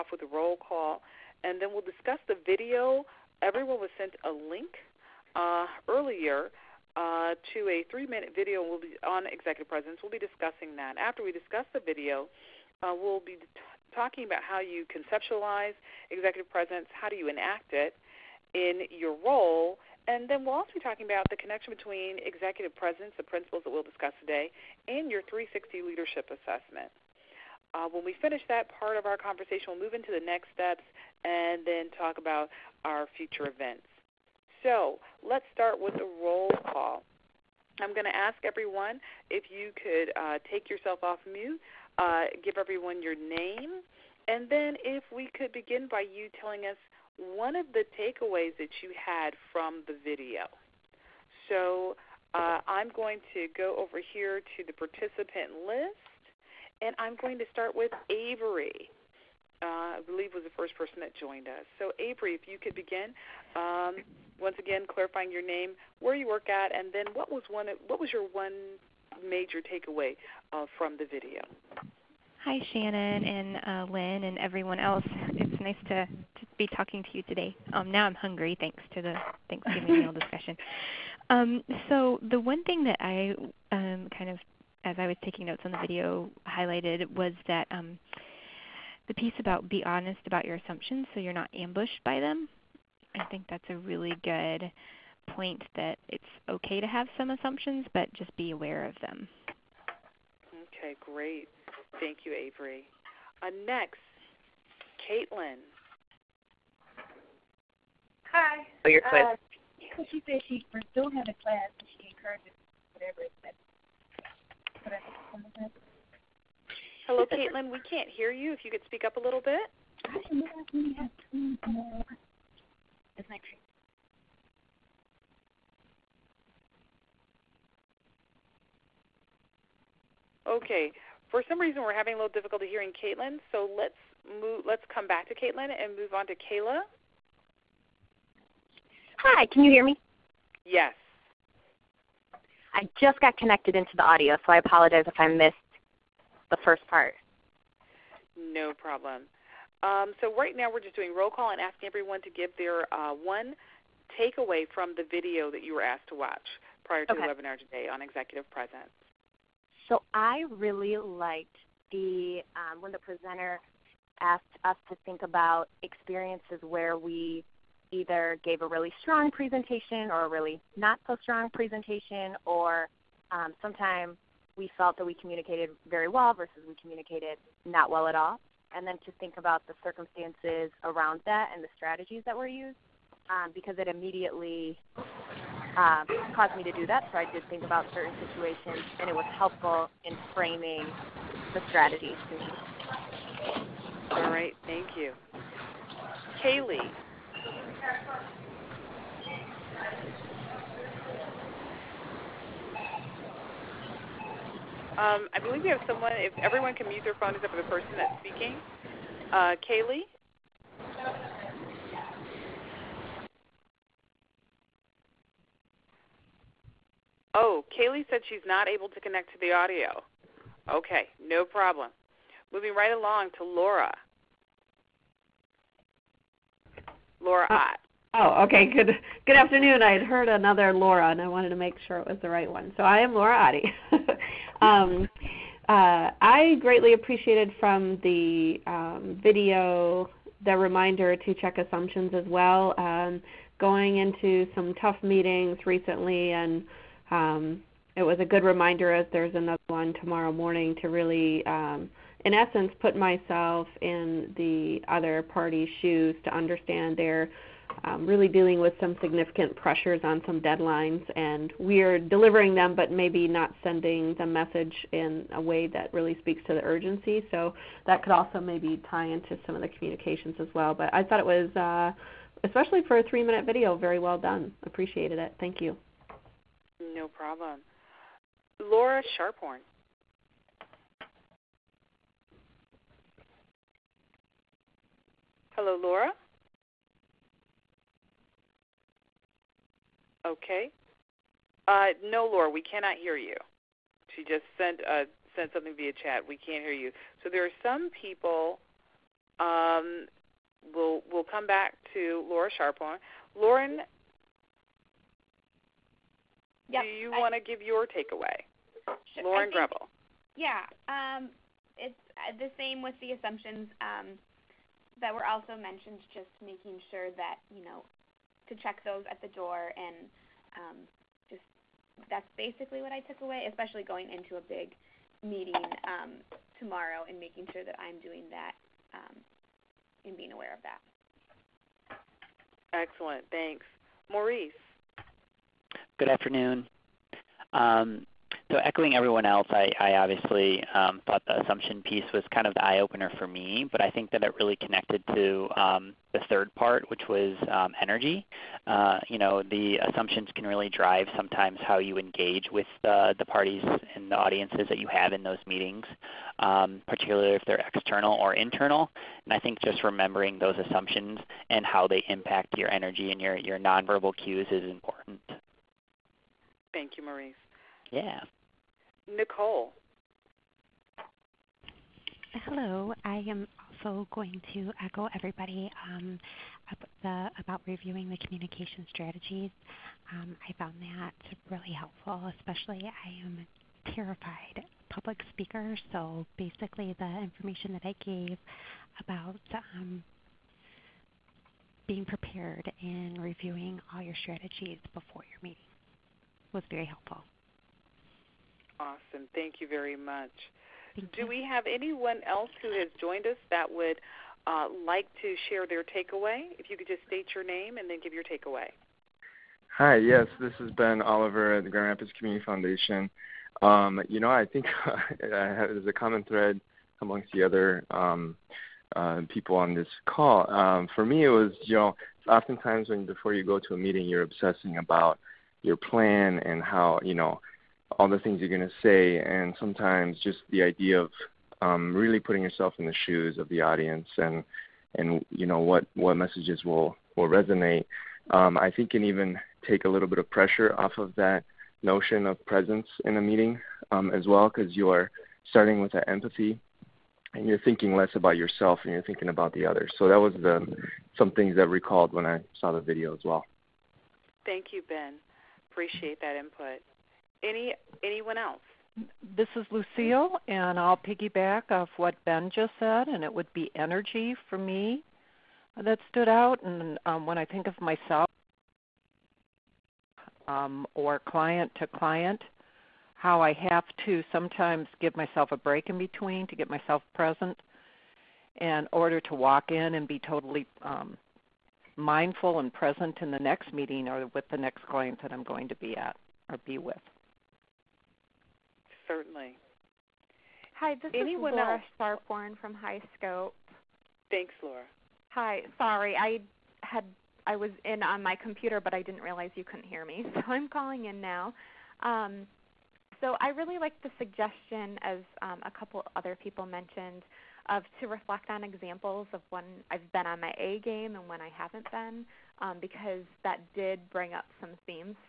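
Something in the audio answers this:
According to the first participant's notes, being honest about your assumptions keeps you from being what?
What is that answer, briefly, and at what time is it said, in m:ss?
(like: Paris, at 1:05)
ambushed, at 1:31.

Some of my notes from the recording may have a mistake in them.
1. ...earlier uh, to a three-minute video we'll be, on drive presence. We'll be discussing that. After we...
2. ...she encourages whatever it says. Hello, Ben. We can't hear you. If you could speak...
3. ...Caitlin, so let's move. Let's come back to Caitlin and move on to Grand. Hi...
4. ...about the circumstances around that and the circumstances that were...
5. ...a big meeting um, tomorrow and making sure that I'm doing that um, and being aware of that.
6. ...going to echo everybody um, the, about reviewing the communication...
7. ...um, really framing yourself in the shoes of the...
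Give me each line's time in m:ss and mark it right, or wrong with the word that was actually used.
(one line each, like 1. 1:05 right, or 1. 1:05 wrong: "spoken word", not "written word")
1. 0:05 wrong: "executive", not "drive"
2. 1:51 wrong: "Caitlin", not "Ben"
3. 2:12 wrong: "Kayla", not "Grand"
4. 2:59 wrong: "strategies", not "circumstances"
5. 5:24 right
6. 6:14 right
7. 7:11 wrong: "putting", not "framing".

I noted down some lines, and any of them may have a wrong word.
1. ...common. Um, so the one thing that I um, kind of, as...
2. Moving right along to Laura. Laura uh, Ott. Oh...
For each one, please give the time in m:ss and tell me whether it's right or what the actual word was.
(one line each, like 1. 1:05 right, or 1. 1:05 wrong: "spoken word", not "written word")
1. 1:20 wrong: "discussion", not "common"
2. 3:42 right.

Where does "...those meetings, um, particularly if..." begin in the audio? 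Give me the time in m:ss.
5:55.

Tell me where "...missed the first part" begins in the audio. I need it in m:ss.
2:25.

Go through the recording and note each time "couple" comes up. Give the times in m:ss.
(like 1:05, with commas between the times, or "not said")
8:25.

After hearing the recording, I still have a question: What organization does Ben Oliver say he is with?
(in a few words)
Grand Rapids Community Foundation.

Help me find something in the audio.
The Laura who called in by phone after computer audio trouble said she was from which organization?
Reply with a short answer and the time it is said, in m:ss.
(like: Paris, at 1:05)
High Scope, at 8:12.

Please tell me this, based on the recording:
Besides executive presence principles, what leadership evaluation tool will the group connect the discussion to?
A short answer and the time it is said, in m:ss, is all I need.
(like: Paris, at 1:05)
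360 leadership assessment, at 0:25.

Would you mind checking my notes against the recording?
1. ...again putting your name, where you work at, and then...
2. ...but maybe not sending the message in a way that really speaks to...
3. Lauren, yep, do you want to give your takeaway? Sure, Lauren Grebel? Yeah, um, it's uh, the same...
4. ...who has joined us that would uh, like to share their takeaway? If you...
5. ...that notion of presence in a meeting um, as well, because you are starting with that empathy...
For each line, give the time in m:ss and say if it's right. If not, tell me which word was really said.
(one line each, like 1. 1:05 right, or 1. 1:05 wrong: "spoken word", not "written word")
1. 1:04 wrong: "clarifying", not "putting"
2. 4:22 right
3. 5:03 right
4. 6:42 right
5. 7:21 right.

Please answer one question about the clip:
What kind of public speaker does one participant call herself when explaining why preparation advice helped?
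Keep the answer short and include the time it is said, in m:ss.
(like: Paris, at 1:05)
terrified, at 6:23.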